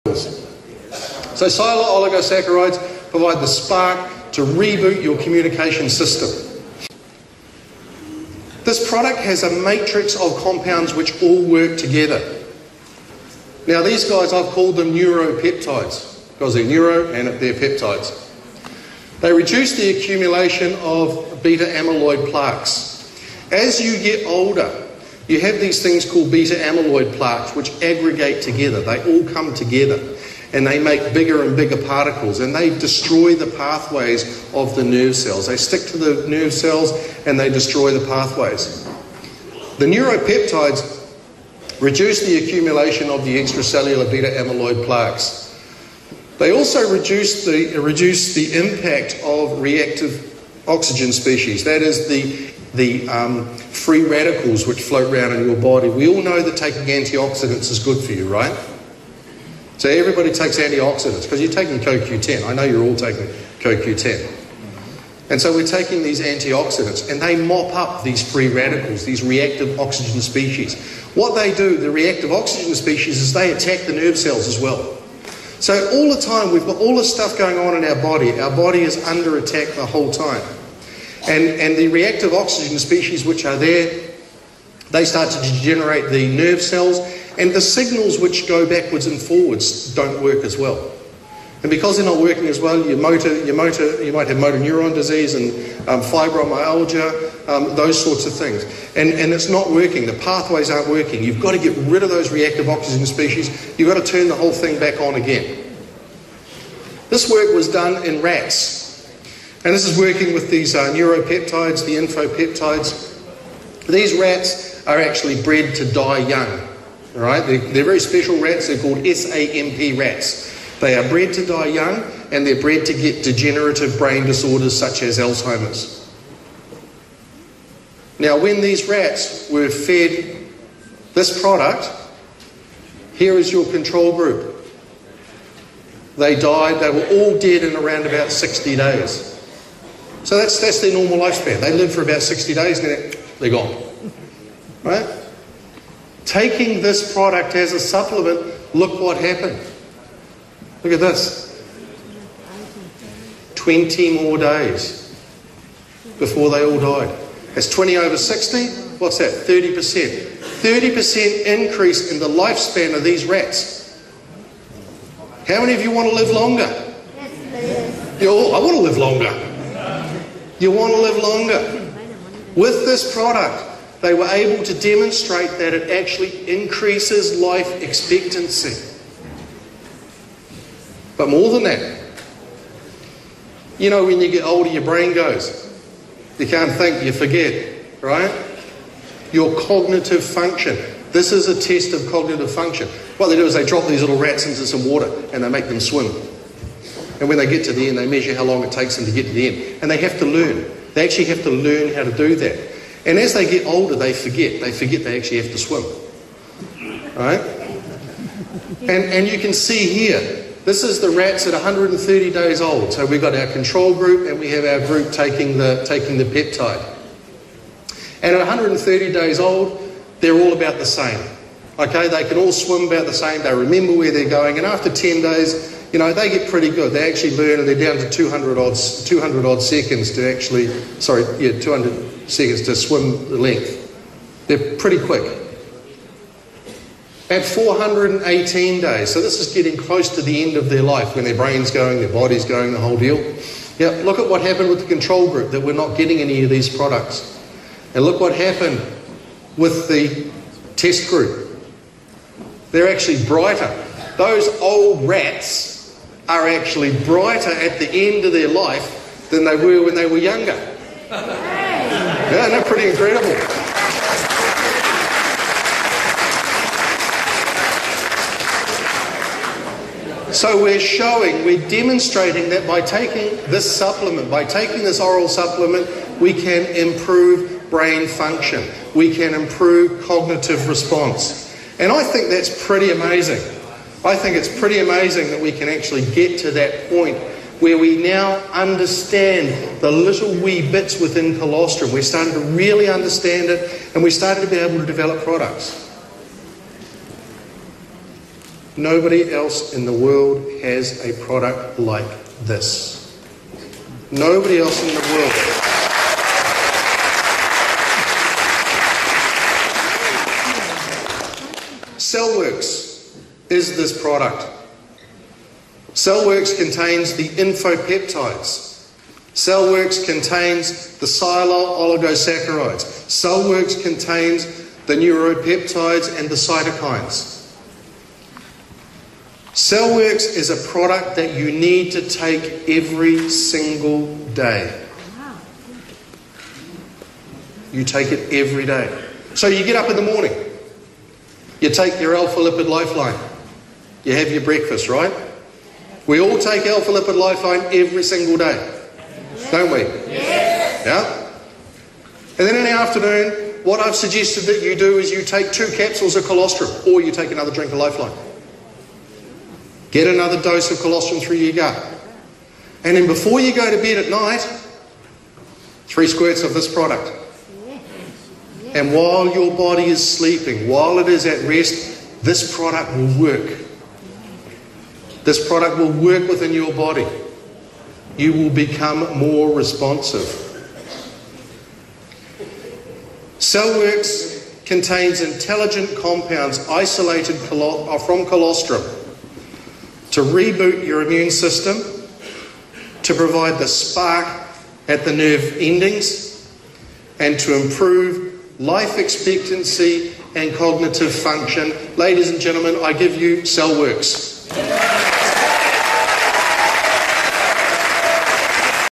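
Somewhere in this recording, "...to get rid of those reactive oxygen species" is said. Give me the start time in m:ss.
1:41.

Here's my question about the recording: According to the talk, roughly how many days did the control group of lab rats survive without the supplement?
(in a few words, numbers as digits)
60 days.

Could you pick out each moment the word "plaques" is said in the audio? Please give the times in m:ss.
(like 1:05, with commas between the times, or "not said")
0:22, 0:27, 0:44.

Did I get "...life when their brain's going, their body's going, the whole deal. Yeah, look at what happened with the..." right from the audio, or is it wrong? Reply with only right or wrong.
right.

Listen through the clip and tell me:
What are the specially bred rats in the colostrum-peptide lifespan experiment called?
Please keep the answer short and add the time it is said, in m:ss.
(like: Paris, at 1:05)
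SAMP rats, at 1:59.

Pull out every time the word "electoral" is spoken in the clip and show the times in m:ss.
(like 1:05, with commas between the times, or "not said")
not said.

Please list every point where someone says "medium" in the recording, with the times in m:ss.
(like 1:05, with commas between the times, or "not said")
not said.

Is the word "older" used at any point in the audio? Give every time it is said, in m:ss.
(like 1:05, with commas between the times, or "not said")
0:24, 3:04, 3:23.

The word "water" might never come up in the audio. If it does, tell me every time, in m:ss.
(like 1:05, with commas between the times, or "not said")
3:14.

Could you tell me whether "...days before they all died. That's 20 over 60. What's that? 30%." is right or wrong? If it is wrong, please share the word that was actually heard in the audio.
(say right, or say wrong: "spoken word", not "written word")
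right.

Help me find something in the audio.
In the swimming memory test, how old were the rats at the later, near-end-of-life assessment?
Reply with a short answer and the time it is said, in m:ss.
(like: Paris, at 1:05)
418 days, at 3:57.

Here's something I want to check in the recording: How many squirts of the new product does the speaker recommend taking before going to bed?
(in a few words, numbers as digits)
3.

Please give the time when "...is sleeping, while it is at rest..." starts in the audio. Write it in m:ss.
6:09.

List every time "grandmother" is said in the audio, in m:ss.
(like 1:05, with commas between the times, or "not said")
not said.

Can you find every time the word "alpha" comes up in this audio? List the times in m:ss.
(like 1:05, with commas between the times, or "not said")
5:42, 5:46.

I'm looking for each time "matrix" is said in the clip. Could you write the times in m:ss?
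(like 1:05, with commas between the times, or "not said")
0:09.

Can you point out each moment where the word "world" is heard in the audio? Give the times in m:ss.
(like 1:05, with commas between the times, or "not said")
4:59, 5:05.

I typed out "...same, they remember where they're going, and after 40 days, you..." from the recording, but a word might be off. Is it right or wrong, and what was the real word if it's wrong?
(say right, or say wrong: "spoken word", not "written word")
wrong: "10", not "40".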